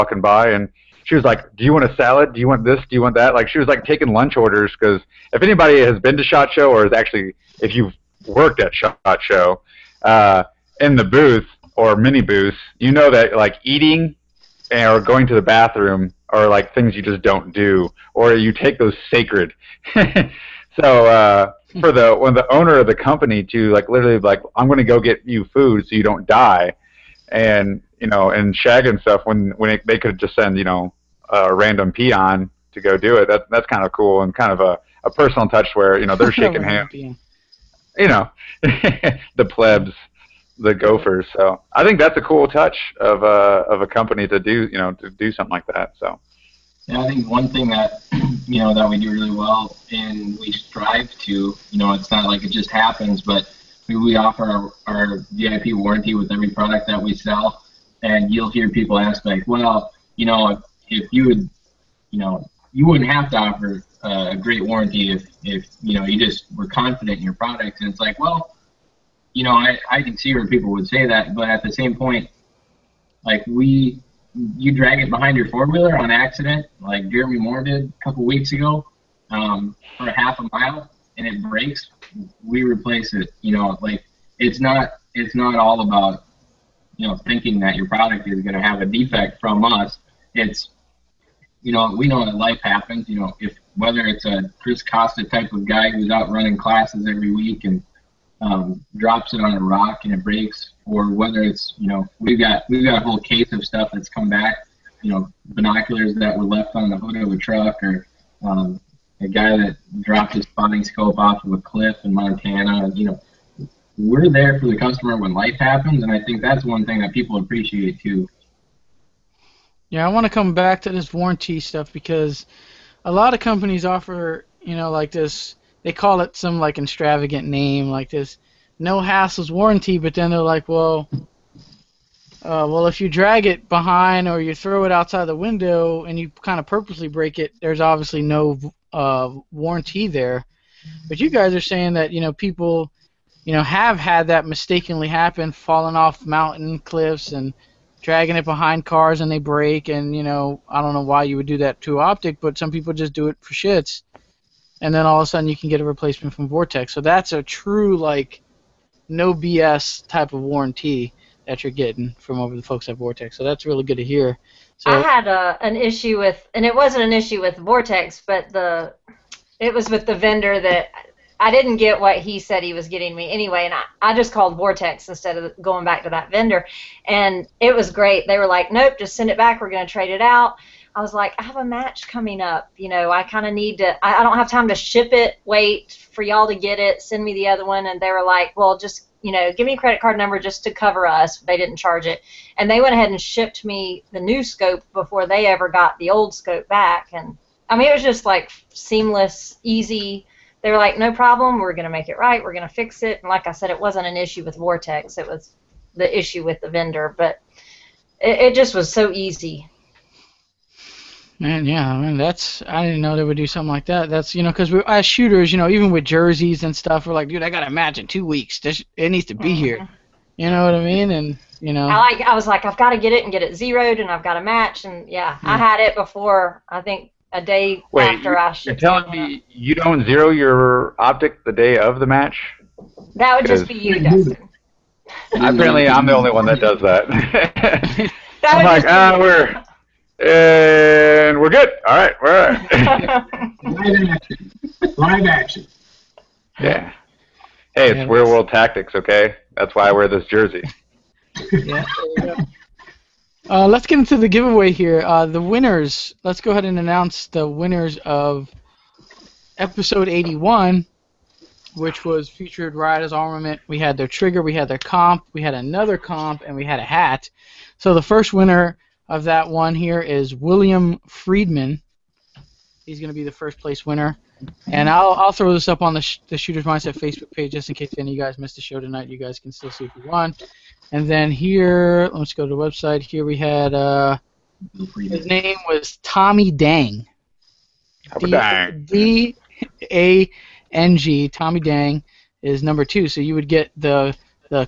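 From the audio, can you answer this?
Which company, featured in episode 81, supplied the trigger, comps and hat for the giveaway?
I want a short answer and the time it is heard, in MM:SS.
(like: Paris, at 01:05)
Rise Armament, at 04:22.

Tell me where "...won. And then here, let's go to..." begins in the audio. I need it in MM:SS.
04:40.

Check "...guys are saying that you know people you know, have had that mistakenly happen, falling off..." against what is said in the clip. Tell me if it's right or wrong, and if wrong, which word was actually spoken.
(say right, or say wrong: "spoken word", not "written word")
right.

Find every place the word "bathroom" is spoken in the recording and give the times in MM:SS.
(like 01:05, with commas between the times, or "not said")
00:15.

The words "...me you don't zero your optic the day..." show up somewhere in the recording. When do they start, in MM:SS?
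03:49.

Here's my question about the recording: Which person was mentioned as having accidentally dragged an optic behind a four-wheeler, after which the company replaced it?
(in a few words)
Jeremy Moore.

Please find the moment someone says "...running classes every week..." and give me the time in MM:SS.
01:36.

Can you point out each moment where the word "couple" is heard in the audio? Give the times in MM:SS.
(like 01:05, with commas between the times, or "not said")
01:18.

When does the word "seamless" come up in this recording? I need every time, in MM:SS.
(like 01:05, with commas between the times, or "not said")
03:18.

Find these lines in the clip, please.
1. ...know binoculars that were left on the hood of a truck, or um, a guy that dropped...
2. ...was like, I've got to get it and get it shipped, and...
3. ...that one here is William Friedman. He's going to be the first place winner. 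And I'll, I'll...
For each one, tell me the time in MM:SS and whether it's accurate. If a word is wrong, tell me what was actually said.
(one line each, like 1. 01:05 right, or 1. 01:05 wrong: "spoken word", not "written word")
1. 01:45 right
2. 03:42 wrong: "zeroed", not "shipped"
3. 04:29 right.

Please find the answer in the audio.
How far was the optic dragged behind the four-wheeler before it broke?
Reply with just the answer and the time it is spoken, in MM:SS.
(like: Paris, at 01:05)
Half a mile, at 01:20.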